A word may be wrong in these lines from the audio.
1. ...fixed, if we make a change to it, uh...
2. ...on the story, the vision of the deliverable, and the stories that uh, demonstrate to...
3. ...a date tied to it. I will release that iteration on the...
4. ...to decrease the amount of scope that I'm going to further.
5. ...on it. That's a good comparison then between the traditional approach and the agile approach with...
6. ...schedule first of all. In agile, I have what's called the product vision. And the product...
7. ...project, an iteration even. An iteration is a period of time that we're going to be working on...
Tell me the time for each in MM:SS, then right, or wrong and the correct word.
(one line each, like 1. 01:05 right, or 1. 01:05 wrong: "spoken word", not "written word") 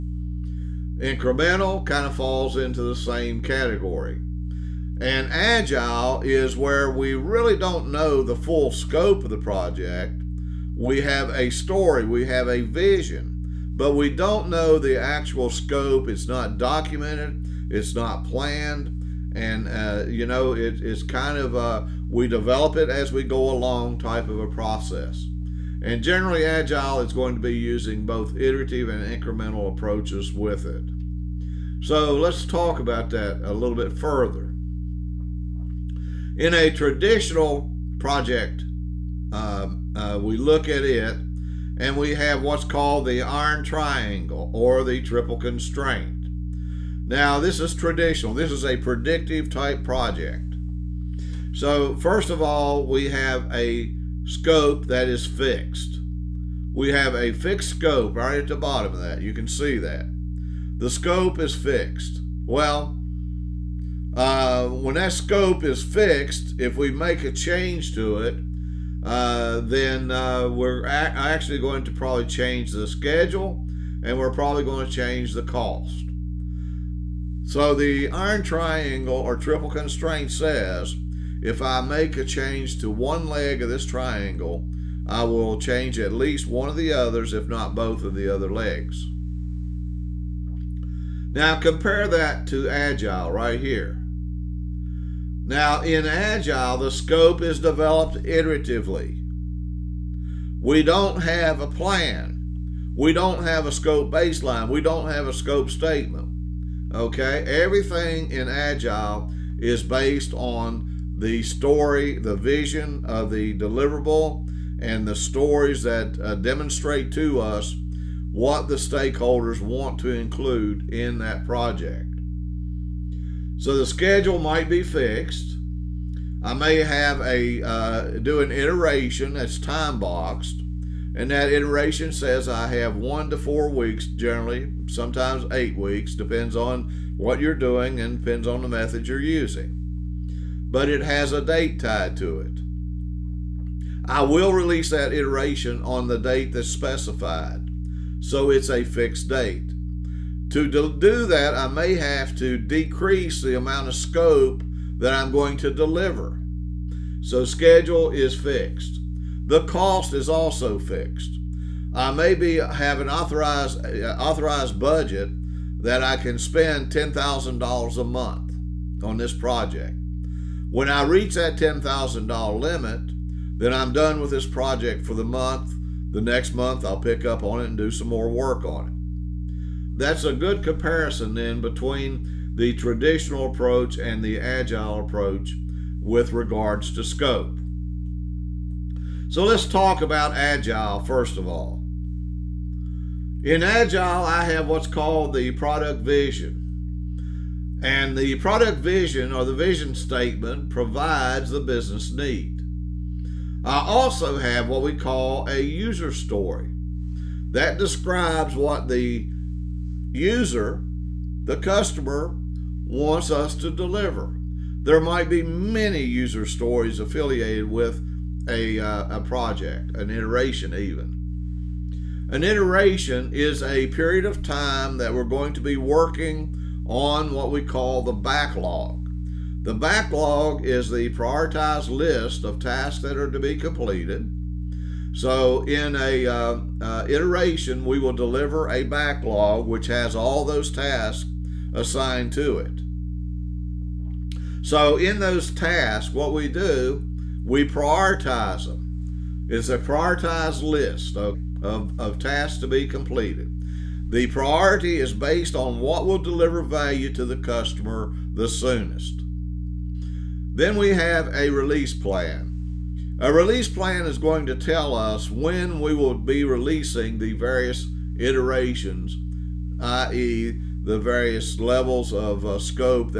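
1. 01:05 right
2. 01:50 right
3. 02:21 right
4. 02:32 wrong: "deliver", not "further"
5. 02:58 right
6. 03:10 wrong: "agile", not "schedule"
7. 03:39 right.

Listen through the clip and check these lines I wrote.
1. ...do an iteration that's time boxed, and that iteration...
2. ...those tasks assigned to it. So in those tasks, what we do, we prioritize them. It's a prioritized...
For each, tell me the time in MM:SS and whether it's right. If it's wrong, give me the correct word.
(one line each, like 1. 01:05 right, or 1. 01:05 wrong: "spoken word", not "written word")
1. 02:08 right
2. 04:00 right.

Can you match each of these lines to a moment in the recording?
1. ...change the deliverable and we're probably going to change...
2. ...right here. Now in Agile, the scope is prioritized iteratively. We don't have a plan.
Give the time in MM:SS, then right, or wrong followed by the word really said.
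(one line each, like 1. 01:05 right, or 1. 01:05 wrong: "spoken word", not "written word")
1. 01:12 wrong: "schedule", not "deliverable"
2. 01:33 wrong: "developed", not "prioritized".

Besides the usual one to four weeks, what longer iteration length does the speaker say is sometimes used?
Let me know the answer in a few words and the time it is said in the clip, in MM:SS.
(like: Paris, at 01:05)
8 weeks, at 02:15.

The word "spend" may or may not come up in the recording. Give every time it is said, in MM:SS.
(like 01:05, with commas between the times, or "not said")
02:46.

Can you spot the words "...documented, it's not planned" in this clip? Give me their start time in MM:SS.
00:16.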